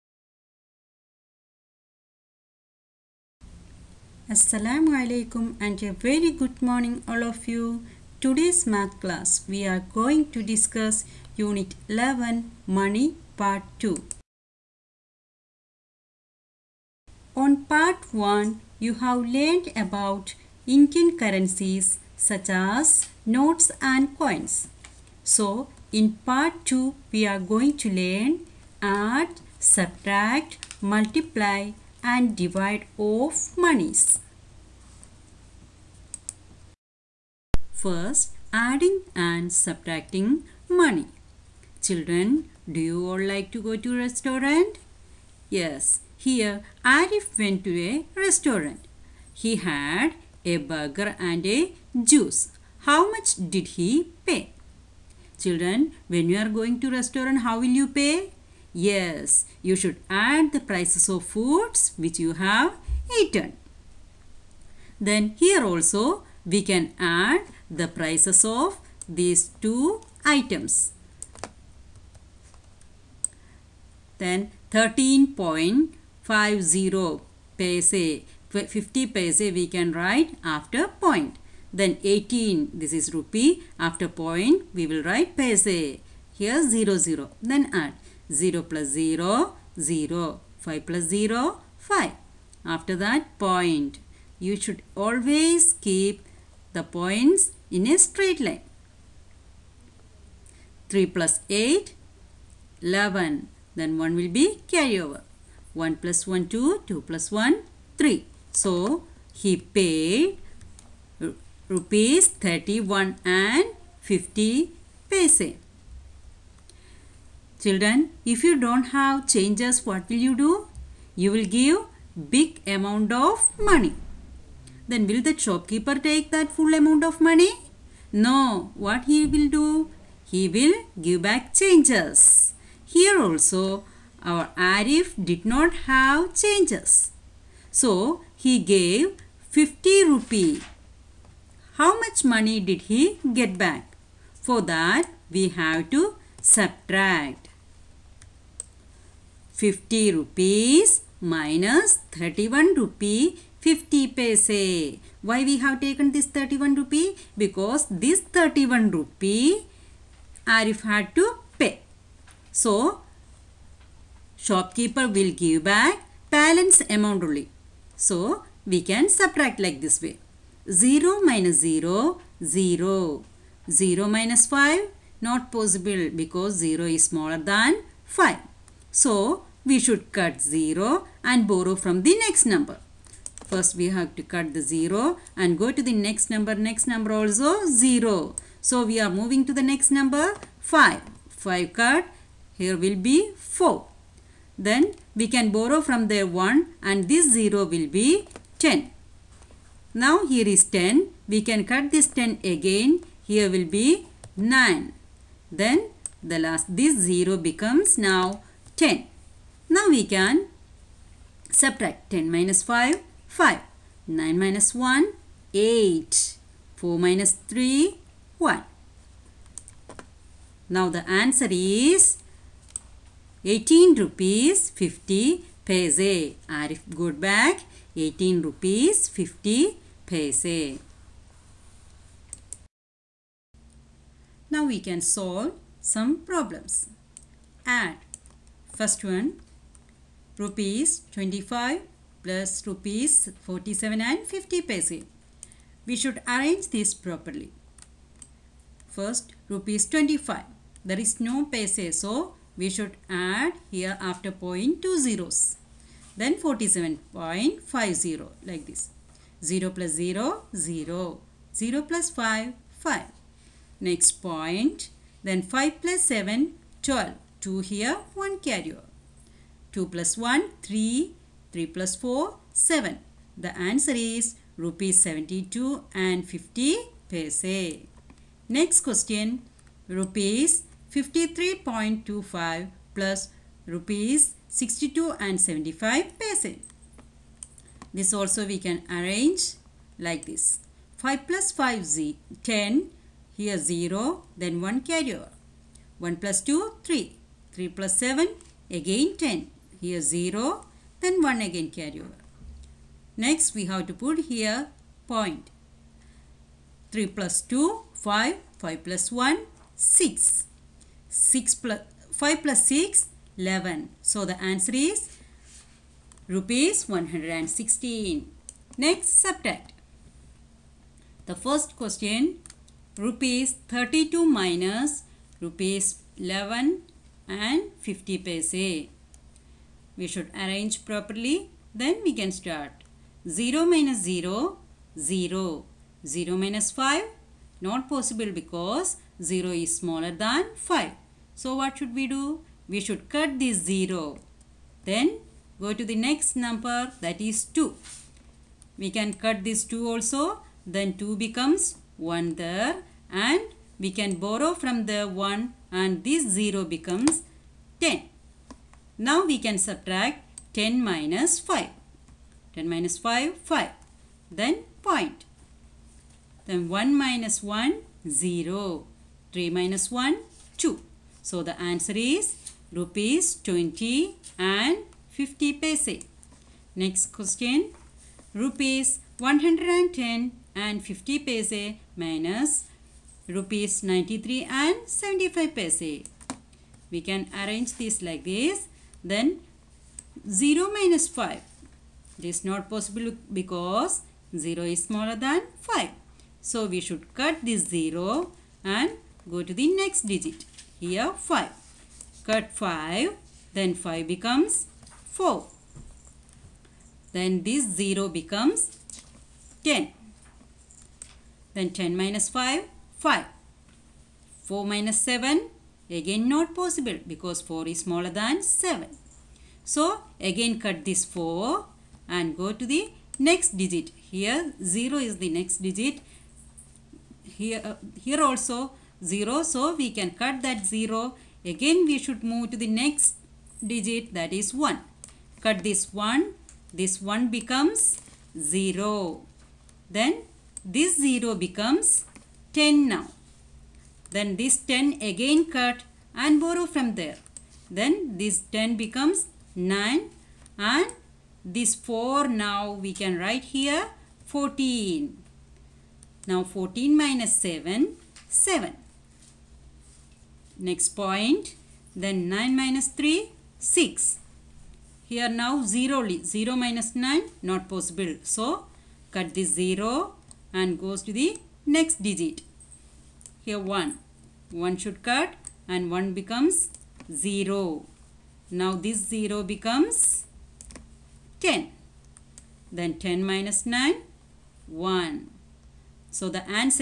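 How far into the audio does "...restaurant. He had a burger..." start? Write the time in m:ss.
0:48.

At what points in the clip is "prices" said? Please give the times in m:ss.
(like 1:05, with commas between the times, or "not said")
1:00, 1:07.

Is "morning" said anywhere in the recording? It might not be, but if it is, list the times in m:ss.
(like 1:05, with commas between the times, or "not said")
0:06.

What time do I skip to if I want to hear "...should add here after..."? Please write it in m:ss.
4:12.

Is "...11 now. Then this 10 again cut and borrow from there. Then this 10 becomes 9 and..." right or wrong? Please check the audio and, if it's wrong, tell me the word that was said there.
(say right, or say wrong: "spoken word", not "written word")
wrong: "10", not "11".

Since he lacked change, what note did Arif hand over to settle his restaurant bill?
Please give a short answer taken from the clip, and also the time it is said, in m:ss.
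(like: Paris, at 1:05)
50 rupee, at 2:19.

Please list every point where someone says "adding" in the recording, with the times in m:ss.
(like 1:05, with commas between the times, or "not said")
0:38.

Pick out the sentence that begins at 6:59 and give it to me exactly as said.
So again cut this 4 and go to the next digit.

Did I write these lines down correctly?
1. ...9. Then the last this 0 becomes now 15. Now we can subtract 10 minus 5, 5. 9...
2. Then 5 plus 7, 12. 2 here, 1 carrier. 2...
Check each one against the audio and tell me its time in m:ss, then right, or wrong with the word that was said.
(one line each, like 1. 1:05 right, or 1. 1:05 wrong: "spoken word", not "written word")
1. 3:24 wrong: "10", not "15"
2. 4:25 right.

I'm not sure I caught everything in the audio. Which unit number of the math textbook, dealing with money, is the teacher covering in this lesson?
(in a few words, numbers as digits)
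11.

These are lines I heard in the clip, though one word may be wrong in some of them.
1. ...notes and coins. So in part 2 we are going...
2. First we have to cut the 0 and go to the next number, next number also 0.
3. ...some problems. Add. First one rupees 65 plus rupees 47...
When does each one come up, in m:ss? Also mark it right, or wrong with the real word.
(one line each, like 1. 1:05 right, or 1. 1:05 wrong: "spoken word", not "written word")
1. 0:23 right
2. 3:03 right
3. 3:55 wrong: "25", not "65".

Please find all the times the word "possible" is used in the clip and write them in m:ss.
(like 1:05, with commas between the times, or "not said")
2:55, 5:37, 6:32, 6:56, 7:47.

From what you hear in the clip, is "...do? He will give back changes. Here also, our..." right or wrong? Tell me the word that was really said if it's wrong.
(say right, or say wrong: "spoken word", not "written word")
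right.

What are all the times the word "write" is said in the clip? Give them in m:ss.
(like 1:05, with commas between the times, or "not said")
1:19, 1:25, 7:33.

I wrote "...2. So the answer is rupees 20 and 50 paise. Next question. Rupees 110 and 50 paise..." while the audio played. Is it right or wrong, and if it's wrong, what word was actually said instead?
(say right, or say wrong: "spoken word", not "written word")
right.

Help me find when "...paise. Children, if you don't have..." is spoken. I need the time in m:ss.
1:55.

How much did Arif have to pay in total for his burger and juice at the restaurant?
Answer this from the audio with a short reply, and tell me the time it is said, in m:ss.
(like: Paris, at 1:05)
Rs 31.50, at 1:51.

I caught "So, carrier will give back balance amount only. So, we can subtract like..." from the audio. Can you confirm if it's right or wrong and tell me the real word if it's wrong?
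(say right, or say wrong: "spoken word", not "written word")
wrong: "shopkeeper", not "carrier".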